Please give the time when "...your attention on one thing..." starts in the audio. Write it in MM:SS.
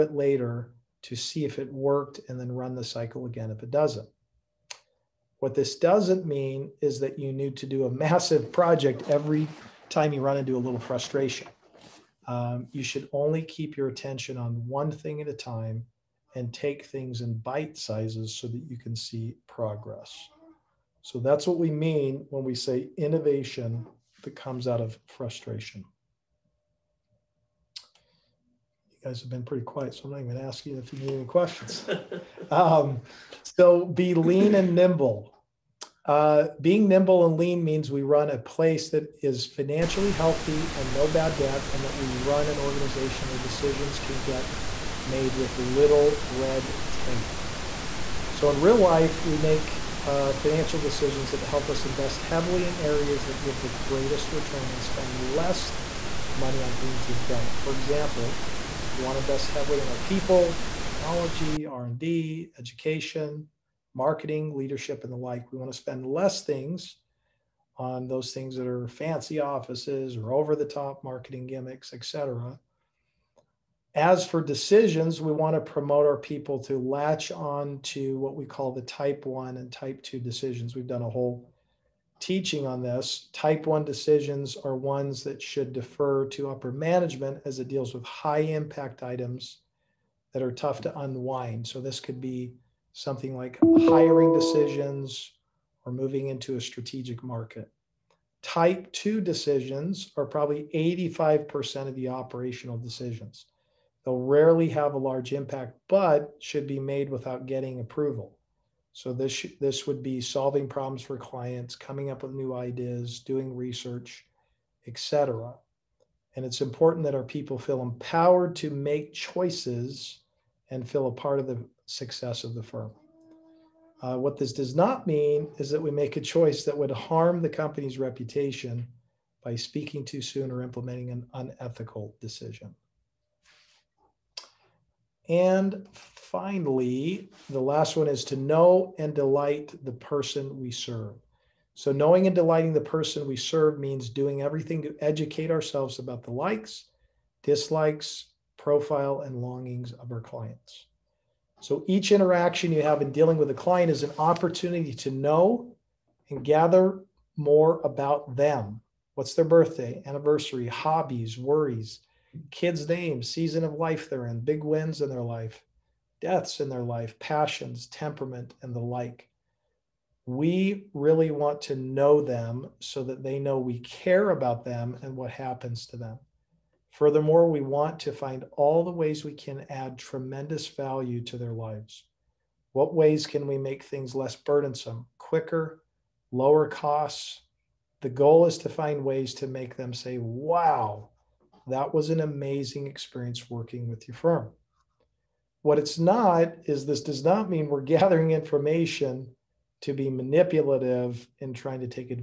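00:13.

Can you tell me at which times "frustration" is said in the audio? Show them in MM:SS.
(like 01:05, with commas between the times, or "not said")
00:10, 00:25.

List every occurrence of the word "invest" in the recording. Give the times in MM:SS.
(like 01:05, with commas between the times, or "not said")
00:51, 00:59.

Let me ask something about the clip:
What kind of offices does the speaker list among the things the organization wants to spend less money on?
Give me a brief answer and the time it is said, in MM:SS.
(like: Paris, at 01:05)
Fancy offices, at 01:08.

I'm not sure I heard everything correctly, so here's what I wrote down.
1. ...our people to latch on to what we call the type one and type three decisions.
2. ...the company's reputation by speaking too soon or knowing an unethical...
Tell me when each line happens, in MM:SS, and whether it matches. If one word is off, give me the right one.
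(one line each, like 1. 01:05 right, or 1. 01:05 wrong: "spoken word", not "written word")
1. 01:16 wrong: "two", not "three"
2. 02:07 wrong: "implementing", not "knowing".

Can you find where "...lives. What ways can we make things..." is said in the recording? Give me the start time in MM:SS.
03:01.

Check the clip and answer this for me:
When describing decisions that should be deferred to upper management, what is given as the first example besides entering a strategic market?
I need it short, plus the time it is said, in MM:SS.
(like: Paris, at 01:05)
Hiring decisions, at 01:33.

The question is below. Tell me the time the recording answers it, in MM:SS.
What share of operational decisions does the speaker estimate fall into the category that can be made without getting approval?
01:40.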